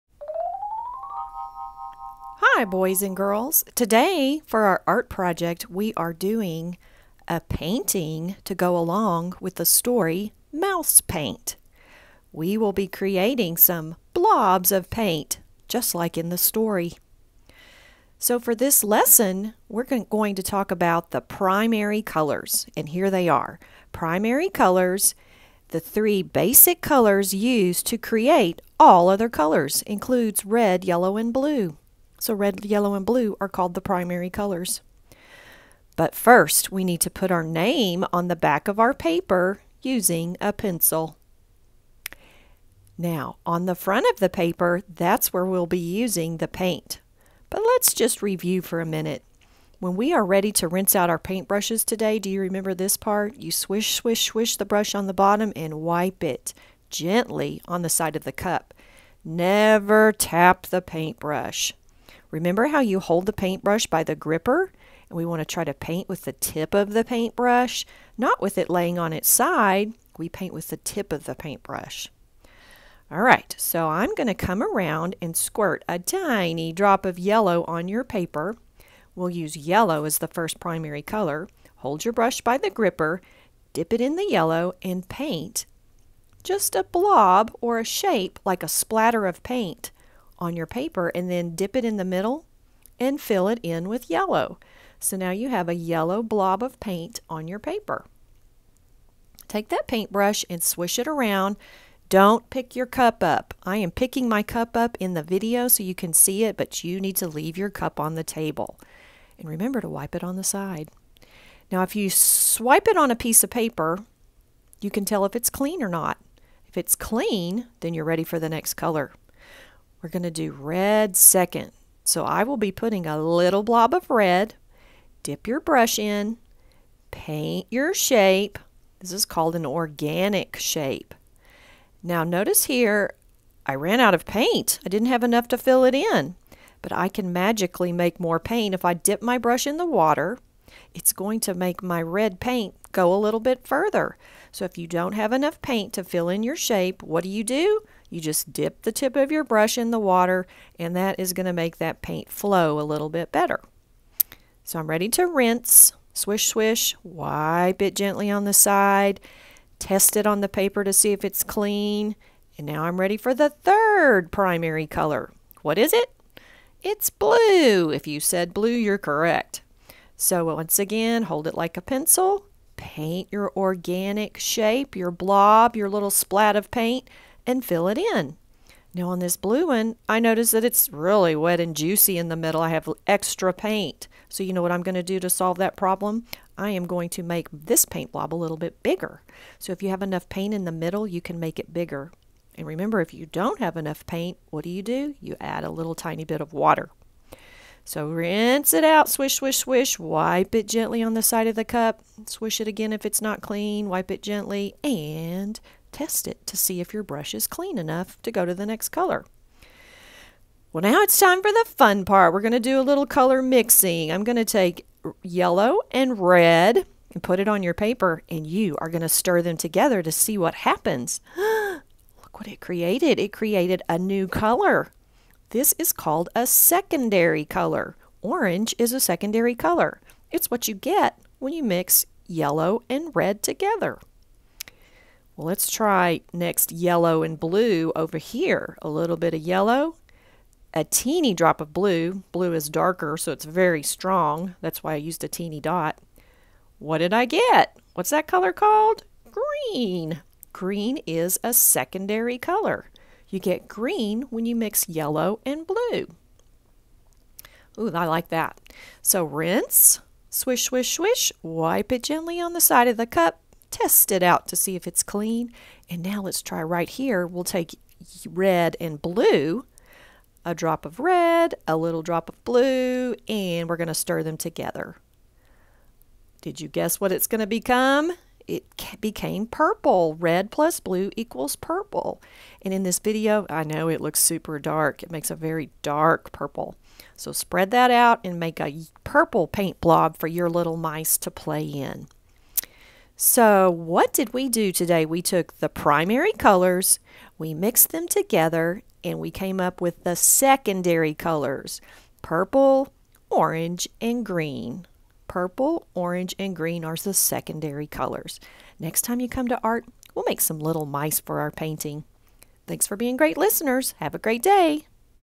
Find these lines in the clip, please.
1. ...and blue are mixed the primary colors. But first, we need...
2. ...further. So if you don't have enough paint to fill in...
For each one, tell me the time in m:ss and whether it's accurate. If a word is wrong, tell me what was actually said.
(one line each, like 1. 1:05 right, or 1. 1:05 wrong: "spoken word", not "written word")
1. 0:32 wrong: "called", not "mixed"
2. 2:23 right.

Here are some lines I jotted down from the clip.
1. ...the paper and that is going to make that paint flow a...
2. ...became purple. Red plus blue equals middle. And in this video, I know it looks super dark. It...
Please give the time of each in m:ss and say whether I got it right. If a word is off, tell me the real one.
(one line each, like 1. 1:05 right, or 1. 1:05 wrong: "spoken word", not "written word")
1. 2:29 wrong: "water", not "paper"
2. 4:38 wrong: "purple", not "middle".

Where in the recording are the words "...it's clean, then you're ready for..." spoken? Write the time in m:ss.
1:56.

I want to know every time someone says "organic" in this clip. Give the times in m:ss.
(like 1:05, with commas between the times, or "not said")
2:09, 2:53.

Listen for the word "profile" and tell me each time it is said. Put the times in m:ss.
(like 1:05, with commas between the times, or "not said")
not said.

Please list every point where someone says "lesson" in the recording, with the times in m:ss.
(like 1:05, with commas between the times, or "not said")
0:18.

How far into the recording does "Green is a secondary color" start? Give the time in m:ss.
4:10.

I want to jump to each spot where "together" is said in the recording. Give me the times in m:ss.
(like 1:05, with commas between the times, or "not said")
3:39, 3:53, 4:34, 4:58.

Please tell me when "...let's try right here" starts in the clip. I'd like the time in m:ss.
4:26.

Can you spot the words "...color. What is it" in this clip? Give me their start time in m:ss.
2:44.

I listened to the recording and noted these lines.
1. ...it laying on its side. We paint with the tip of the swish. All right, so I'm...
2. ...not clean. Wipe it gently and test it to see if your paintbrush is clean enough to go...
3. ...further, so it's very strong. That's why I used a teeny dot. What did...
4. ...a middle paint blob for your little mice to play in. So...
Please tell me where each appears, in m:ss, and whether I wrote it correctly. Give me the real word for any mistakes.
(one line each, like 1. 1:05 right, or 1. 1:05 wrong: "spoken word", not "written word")
1. 1:08 wrong: "paintbrush", not "swish"
2. 3:23 wrong: "brush", not "paintbrush"
3. 4:02 wrong: "darker", not "further"
4. 4:48 wrong: "purple", not "middle".